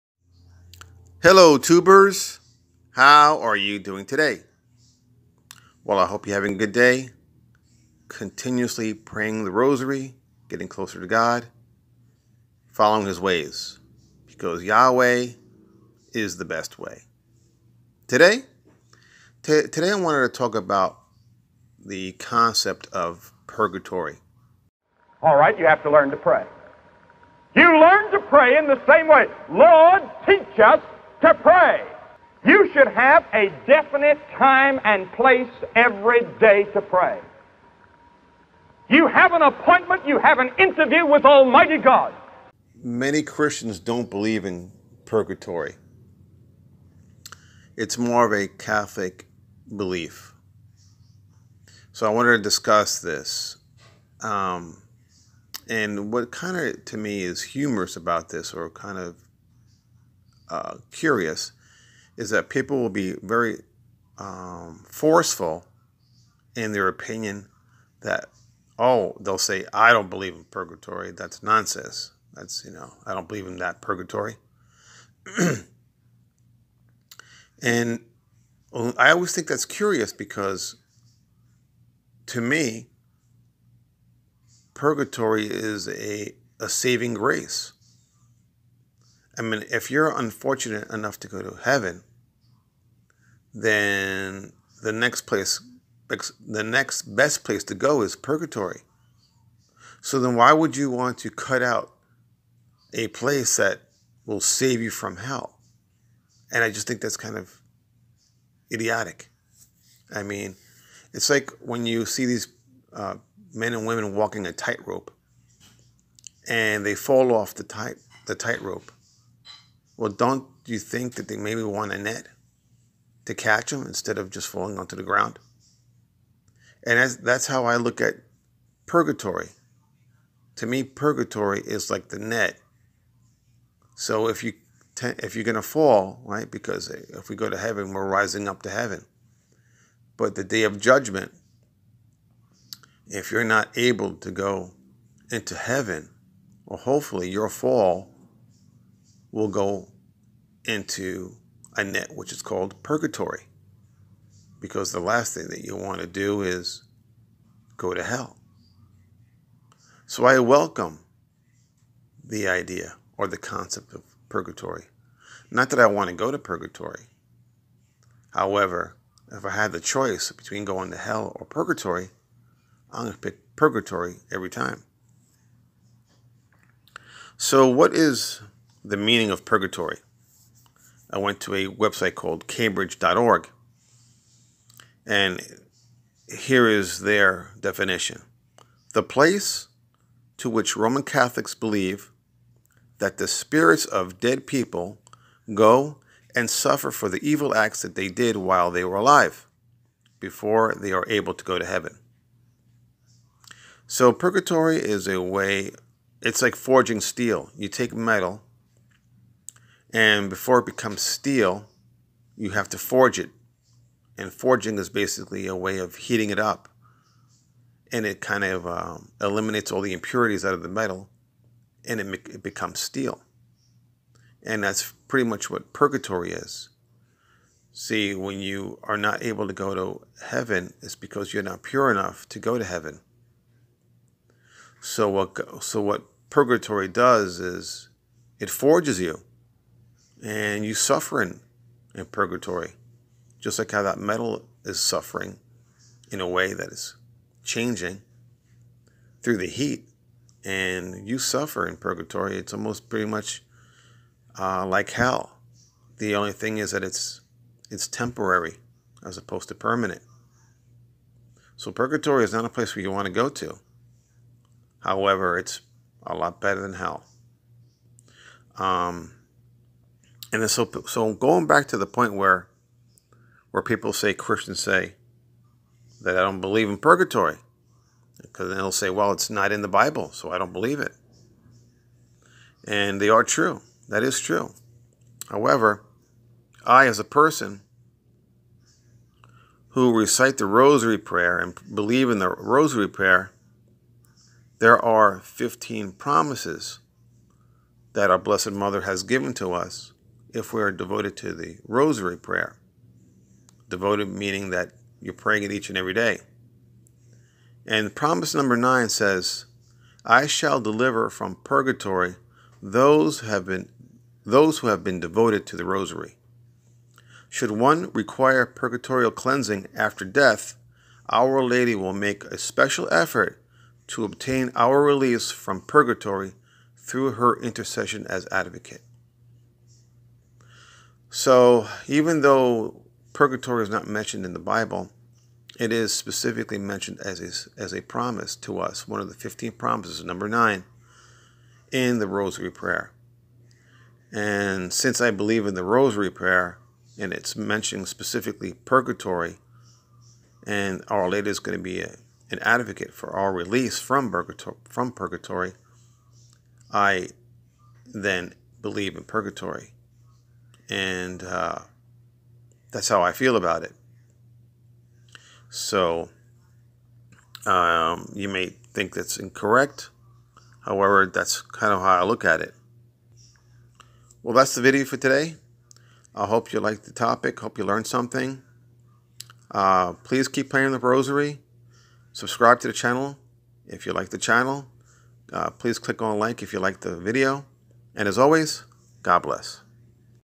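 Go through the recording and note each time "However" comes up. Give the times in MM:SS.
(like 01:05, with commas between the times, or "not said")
02:48, 04:24, 04:45, 06:10.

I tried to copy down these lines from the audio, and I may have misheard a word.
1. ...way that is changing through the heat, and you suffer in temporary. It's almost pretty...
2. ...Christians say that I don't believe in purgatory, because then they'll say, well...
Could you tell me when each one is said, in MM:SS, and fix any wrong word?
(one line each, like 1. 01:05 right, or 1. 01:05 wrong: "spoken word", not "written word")
1. 04:06 wrong: "purgatory", not "temporary"
2. 04:34 right.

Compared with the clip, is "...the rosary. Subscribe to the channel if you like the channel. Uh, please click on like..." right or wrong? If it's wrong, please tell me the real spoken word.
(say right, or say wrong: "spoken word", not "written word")
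right.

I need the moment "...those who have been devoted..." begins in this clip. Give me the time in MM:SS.
05:14.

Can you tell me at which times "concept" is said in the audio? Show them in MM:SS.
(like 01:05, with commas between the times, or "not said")
00:22, 02:43.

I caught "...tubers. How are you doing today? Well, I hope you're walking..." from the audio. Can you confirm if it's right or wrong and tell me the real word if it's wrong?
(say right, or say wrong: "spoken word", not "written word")
wrong: "having", not "walking".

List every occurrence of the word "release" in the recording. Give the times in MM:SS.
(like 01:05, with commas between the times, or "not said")
05:24, 05:53.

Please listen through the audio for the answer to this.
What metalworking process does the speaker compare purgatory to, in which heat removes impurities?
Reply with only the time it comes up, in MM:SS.
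03:26.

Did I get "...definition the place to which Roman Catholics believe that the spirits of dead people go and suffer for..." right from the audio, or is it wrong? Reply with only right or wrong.
right.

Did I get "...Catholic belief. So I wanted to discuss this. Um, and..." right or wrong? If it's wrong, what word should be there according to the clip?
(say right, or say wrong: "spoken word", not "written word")
right.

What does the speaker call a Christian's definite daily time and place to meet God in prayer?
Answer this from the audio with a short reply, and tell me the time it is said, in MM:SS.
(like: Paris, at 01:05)
An appointment, at 00:39.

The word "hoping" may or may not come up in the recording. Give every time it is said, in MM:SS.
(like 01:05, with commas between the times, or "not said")
not said.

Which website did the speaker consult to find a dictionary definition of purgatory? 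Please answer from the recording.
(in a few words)
cambridge.org.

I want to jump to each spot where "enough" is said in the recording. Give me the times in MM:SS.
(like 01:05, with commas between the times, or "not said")
01:30, 03:51.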